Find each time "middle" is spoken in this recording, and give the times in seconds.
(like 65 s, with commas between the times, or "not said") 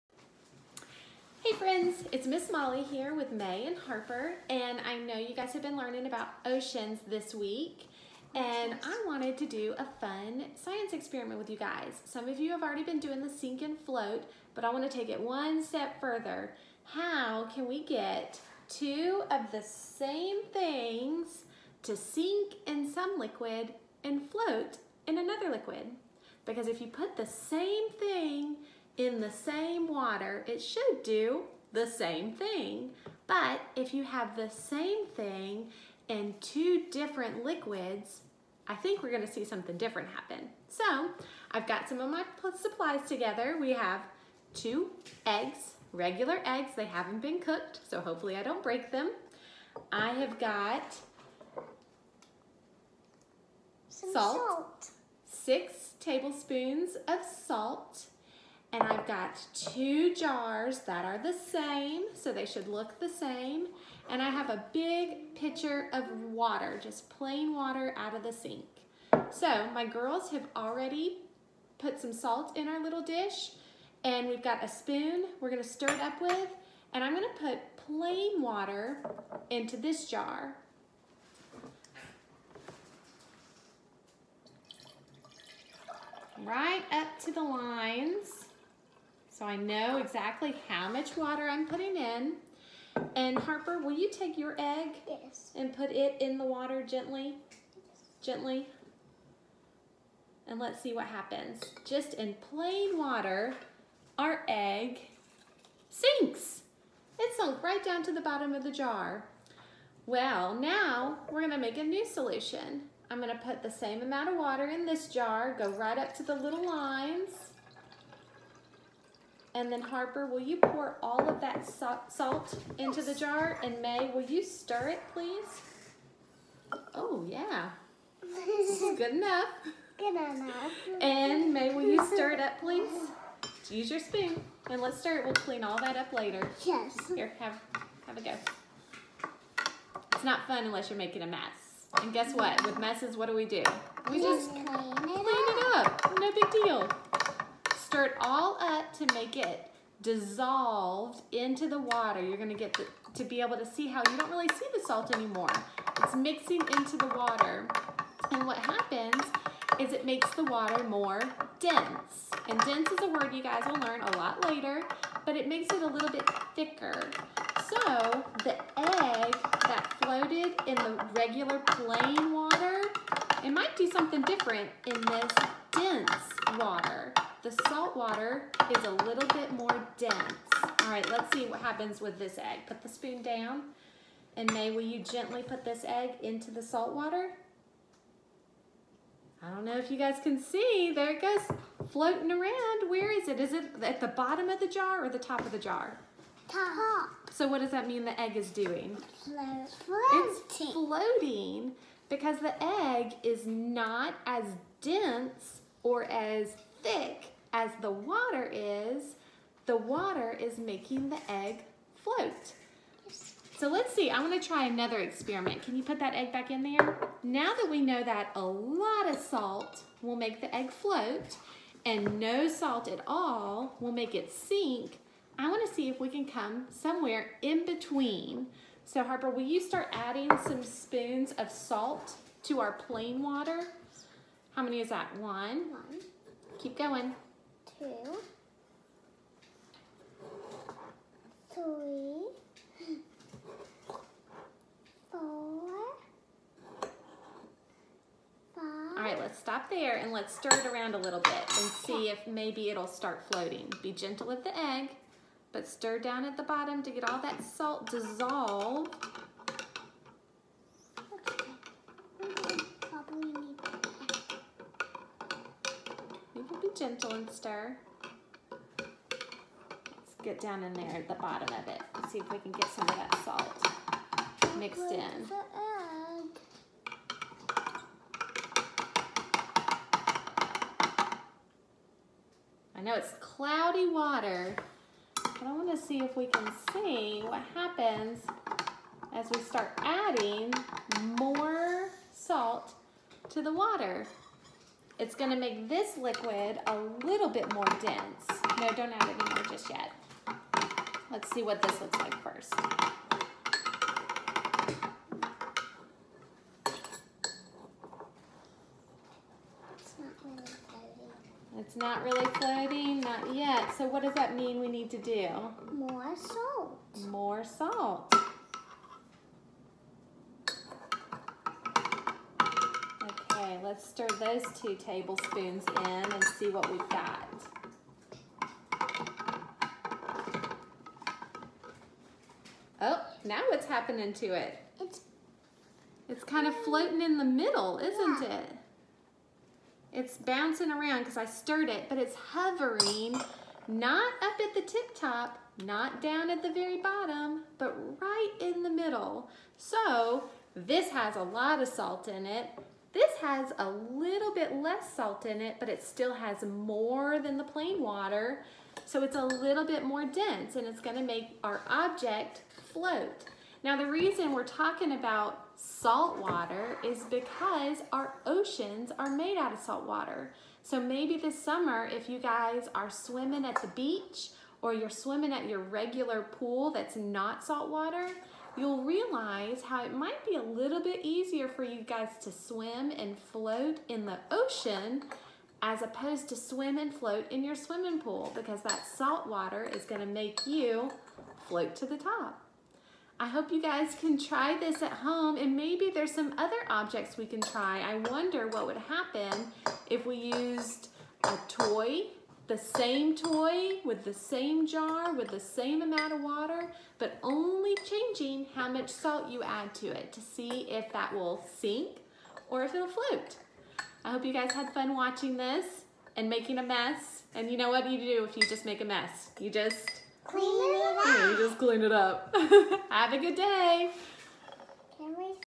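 337 s, 348 s.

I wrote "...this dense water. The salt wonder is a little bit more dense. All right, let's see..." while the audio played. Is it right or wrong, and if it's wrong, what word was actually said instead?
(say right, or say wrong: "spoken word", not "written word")
wrong: "water", not "wonder".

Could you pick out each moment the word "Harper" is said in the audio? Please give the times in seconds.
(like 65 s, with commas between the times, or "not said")
3 s, 93 s, 119 s, 229 s.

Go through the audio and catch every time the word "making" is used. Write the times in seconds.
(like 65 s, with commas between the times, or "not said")
140 s, 210 s, 416 s.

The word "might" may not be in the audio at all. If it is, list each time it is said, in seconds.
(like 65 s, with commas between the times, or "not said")
173 s, 379 s.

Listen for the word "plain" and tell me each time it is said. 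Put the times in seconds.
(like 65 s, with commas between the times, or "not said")
67 s, 77 s, 102 s, 171 s, 232 s, 357 s.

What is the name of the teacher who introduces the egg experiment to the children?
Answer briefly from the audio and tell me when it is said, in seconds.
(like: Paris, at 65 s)
Miss Molly, at 2 s.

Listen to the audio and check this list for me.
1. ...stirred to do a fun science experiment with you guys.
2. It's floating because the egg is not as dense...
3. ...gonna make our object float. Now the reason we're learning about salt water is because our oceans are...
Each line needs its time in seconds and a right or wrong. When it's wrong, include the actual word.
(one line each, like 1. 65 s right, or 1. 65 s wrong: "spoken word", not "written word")
1. 9 s wrong: "wanted", not "stirred"
2. 200 s right
3. 360 s wrong: "talking", not "learning".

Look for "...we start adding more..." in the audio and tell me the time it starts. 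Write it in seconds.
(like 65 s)
289 s.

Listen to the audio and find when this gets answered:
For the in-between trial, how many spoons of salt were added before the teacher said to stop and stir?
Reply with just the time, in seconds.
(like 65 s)
248 s.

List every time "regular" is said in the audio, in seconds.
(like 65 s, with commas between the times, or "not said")
45 s, 171 s, 375 s.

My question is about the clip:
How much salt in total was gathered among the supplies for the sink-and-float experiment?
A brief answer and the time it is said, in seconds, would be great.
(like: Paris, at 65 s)
6 tablespoons, at 55 s.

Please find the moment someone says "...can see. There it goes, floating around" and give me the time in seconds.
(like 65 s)
190 s.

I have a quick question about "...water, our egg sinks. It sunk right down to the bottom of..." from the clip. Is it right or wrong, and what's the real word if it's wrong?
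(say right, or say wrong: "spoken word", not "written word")
right.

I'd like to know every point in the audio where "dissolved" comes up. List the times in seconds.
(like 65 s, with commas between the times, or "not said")
150 s, 257 s.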